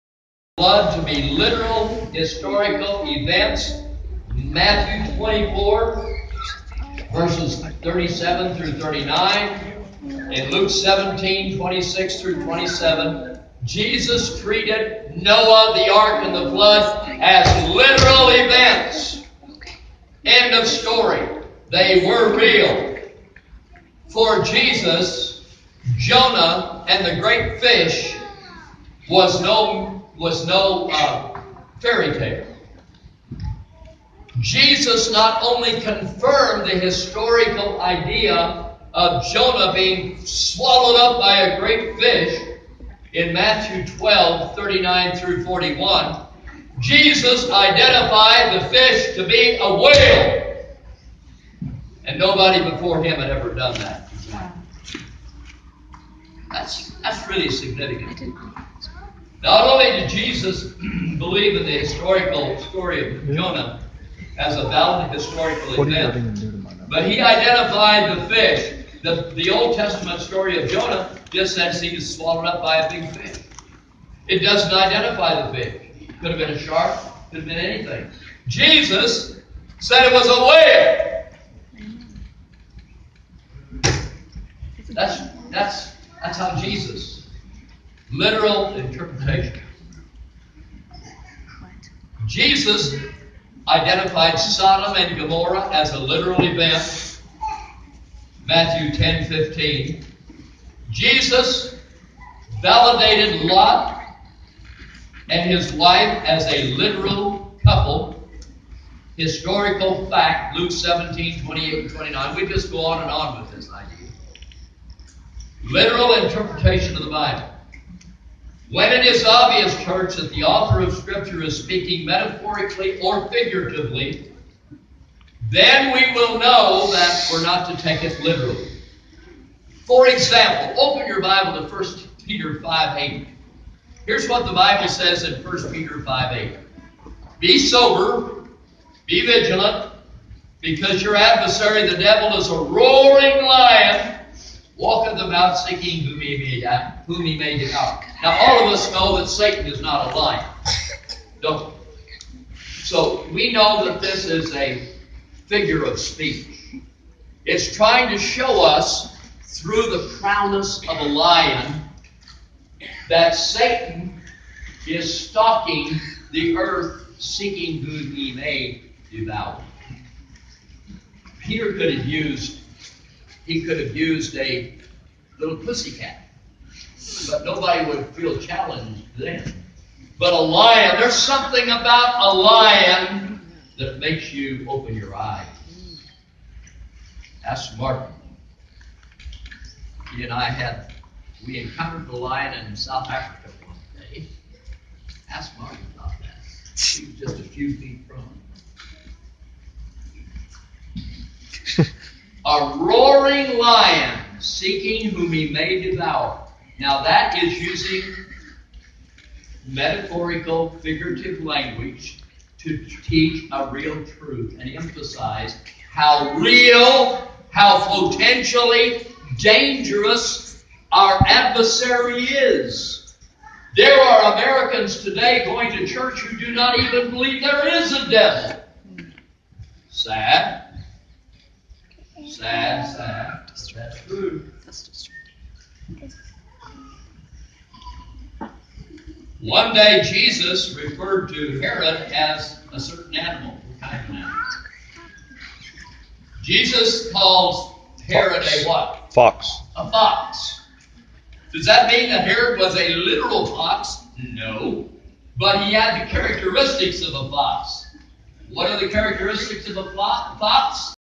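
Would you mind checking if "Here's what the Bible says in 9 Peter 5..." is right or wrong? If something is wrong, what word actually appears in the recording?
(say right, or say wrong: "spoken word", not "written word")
wrong: "1", not "9".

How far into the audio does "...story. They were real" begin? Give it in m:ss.
0:20.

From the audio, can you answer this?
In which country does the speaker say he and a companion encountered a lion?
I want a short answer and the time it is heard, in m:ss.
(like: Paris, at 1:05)
South Africa, at 3:12.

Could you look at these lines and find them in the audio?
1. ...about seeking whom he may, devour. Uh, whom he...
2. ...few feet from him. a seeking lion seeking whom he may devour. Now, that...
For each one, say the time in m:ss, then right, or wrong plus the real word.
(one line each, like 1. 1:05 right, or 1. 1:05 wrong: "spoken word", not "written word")
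1. 2:25 right
2. 3:17 wrong: "roaring", not "seeking".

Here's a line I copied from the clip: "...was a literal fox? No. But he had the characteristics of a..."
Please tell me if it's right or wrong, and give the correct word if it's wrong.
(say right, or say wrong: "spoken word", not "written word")
right.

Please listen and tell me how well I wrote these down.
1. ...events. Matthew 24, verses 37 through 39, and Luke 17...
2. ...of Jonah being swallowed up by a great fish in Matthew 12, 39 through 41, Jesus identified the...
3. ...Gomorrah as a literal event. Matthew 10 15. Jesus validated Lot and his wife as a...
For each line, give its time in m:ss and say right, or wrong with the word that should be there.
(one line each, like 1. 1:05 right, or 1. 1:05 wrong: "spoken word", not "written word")
1. 0:03 right
2. 0:38 right
3. 1:35 right.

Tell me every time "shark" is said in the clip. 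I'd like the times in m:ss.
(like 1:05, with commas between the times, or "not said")
1:16.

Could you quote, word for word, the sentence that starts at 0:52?
And nobody before him had ever done that.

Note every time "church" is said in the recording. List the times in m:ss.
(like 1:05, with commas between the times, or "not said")
1:59, 3:45.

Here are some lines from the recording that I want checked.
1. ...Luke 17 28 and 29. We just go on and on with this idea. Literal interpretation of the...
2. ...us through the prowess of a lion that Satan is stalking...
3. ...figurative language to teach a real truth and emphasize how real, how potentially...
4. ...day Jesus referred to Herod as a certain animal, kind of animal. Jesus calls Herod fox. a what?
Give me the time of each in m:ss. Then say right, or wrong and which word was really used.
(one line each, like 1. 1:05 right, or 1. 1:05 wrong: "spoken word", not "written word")
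1. 1:50 right
2. 2:38 right
3. 3:30 right
4. 3:59 right.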